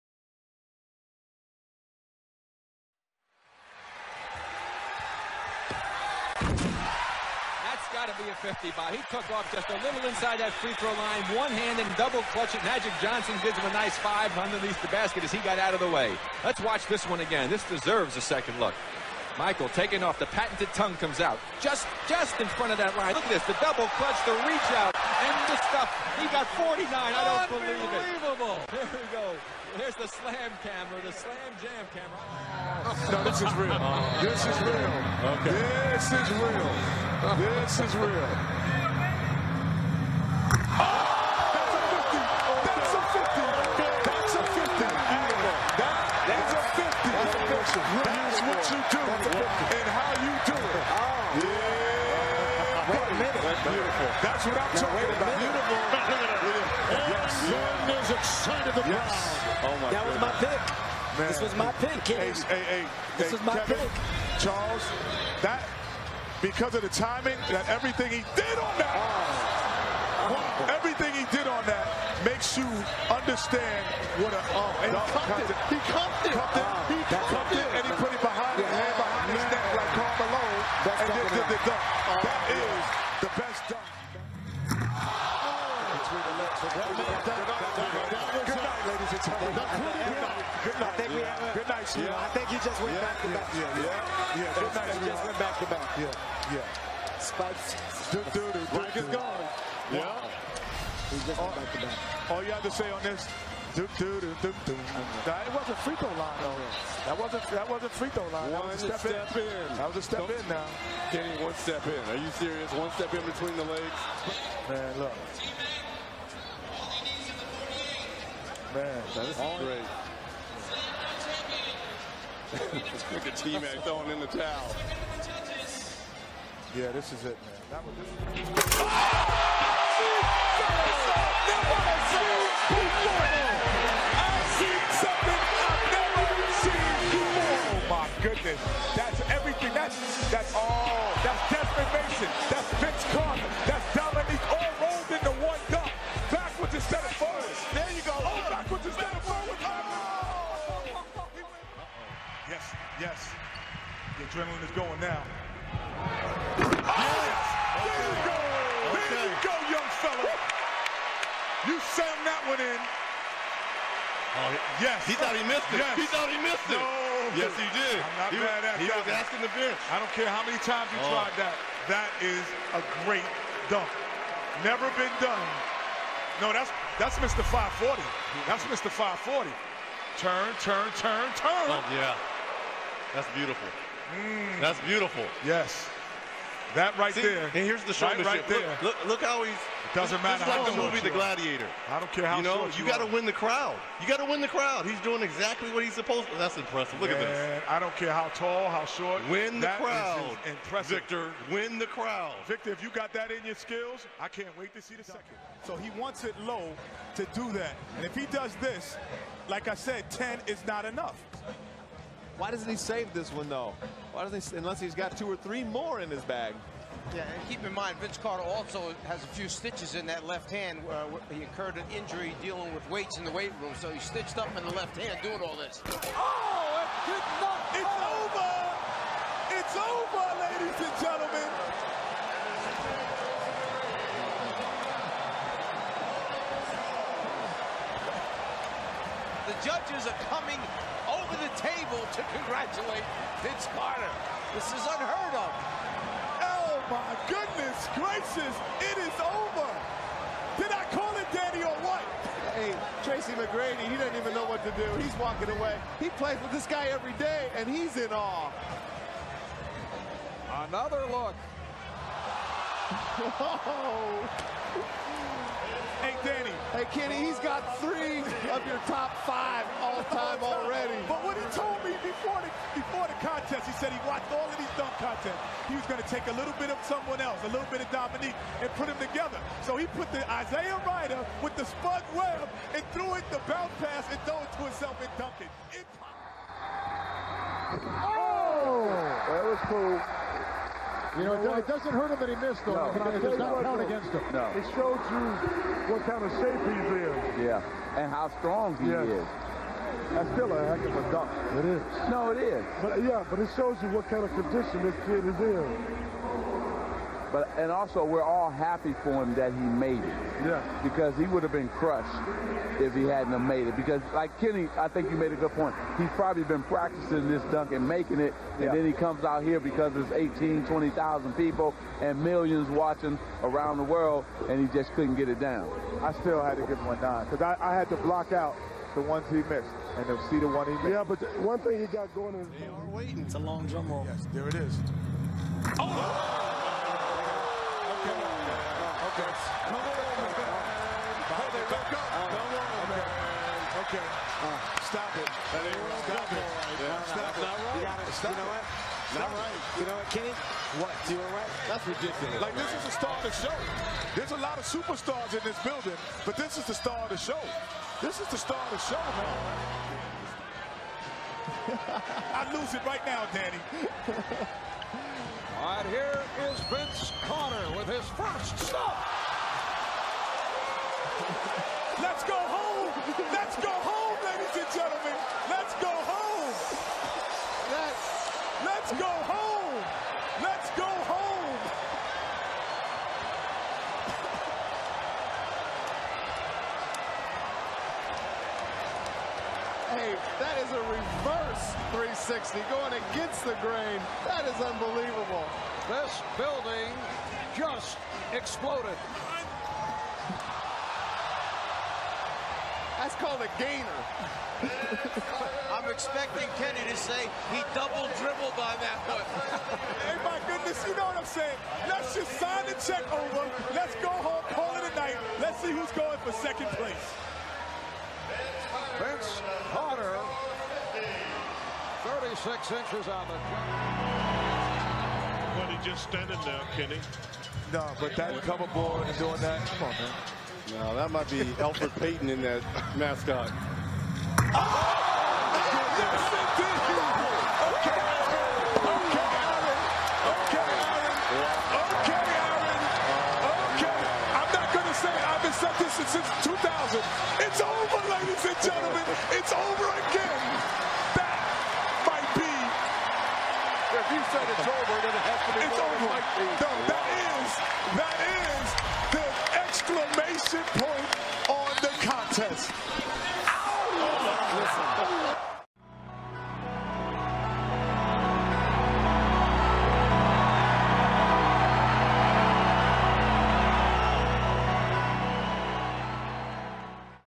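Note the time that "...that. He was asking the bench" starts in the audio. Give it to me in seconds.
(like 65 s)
168 s.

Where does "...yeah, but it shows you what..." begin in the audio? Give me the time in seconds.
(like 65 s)
303 s.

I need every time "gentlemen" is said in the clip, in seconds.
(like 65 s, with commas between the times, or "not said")
230 s, 374 s, 448 s.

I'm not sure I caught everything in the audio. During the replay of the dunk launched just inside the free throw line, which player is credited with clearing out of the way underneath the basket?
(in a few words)
Magic Johnson.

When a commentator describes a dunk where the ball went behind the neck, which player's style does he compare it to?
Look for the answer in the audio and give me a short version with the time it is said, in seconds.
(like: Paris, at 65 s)
Karl Malone, at 79 s.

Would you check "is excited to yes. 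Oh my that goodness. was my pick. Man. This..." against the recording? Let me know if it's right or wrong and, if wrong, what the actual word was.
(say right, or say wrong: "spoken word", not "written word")
right.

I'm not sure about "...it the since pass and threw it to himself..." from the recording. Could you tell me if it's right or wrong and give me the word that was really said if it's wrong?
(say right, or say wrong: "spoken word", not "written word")
wrong: "bounce", not "since".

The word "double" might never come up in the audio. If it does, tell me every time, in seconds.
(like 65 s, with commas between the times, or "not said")
11 s, 23 s, 407 s.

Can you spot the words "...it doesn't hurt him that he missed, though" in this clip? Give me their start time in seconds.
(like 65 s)
291 s.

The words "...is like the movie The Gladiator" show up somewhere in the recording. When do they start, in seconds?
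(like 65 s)
190 s.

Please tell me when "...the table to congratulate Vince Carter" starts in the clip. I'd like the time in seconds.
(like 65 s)
241 s.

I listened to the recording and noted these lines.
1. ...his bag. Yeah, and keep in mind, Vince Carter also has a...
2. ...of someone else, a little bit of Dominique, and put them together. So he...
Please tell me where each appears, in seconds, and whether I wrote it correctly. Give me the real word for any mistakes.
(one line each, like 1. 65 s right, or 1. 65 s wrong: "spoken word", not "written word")
1. 216 s right
2. 276 s right.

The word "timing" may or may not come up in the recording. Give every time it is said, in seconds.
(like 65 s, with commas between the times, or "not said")
66 s.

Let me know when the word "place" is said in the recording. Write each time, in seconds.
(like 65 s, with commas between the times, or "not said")
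416 s.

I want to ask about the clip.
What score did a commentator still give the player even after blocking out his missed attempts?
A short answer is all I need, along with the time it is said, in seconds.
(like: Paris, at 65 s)
9, at 326 s.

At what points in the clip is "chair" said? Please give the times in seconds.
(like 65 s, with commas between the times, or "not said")
not said.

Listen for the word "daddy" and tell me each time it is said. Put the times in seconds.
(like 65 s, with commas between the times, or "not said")
251 s.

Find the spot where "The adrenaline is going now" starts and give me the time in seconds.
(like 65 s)
154 s.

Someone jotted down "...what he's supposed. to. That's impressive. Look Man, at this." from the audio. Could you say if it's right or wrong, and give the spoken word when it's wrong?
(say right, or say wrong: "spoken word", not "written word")
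right.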